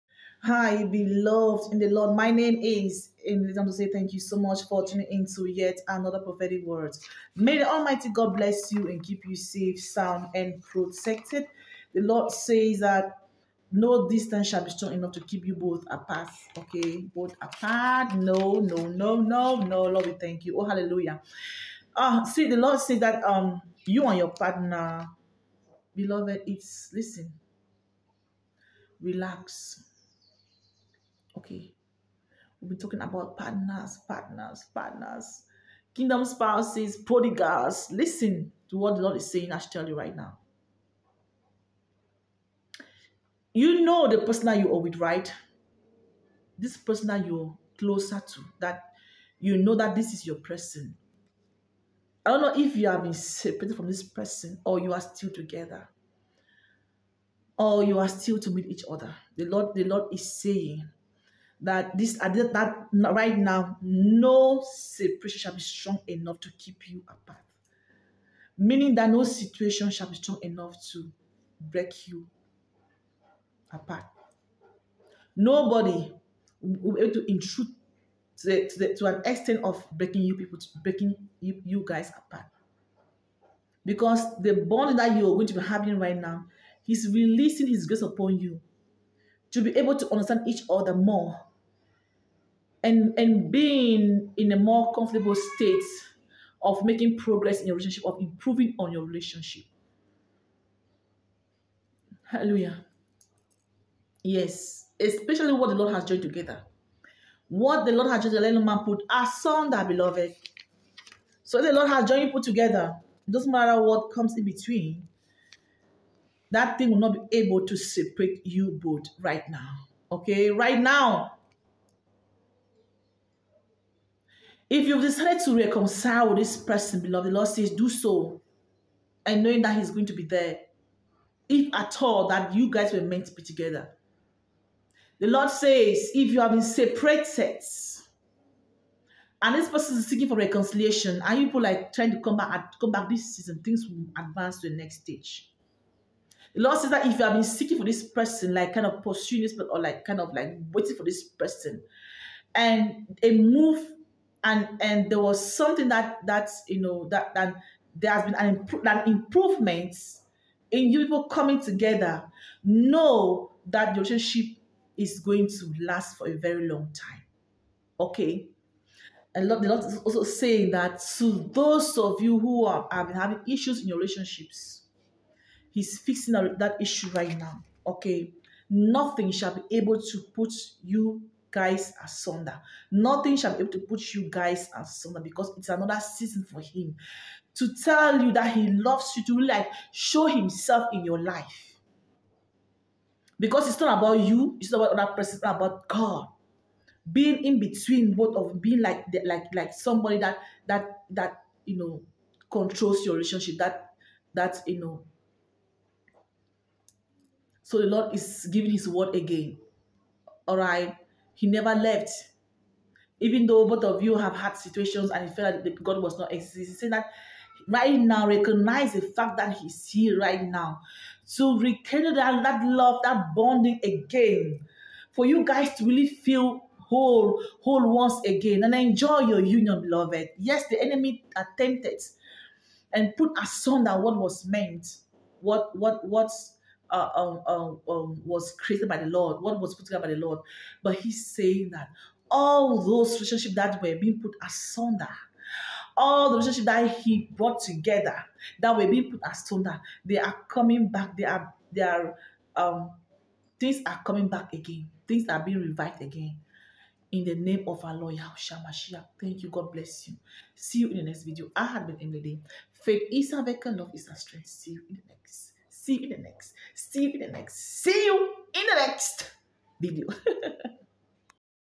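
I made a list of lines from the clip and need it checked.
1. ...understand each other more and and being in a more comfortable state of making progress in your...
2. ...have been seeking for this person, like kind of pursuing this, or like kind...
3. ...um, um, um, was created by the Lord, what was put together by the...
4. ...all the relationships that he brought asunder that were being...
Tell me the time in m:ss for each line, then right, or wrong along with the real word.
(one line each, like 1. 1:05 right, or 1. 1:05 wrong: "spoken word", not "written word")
1. 1:30 right
2. 2:27 right
3. 3:57 right
4. 4:05 wrong: "together", not "asunder".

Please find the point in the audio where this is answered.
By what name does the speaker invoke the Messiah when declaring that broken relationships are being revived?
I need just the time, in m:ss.
4:18.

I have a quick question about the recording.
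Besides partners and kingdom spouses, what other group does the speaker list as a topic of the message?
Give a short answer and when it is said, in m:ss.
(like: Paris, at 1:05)
prodigals, at 0:36.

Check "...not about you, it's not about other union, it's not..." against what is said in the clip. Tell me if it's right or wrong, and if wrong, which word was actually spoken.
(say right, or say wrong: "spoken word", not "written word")
wrong: "person", not "union".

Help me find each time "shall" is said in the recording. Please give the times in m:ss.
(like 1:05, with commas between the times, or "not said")
0:14, 1:05, 1:09, 2:59, 3:03.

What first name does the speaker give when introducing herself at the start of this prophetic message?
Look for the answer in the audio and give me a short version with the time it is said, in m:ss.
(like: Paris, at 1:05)
Emily, at 0:03.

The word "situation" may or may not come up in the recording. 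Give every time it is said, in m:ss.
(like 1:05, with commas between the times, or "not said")
1:09, 3:34.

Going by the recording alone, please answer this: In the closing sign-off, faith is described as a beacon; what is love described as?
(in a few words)
a strength.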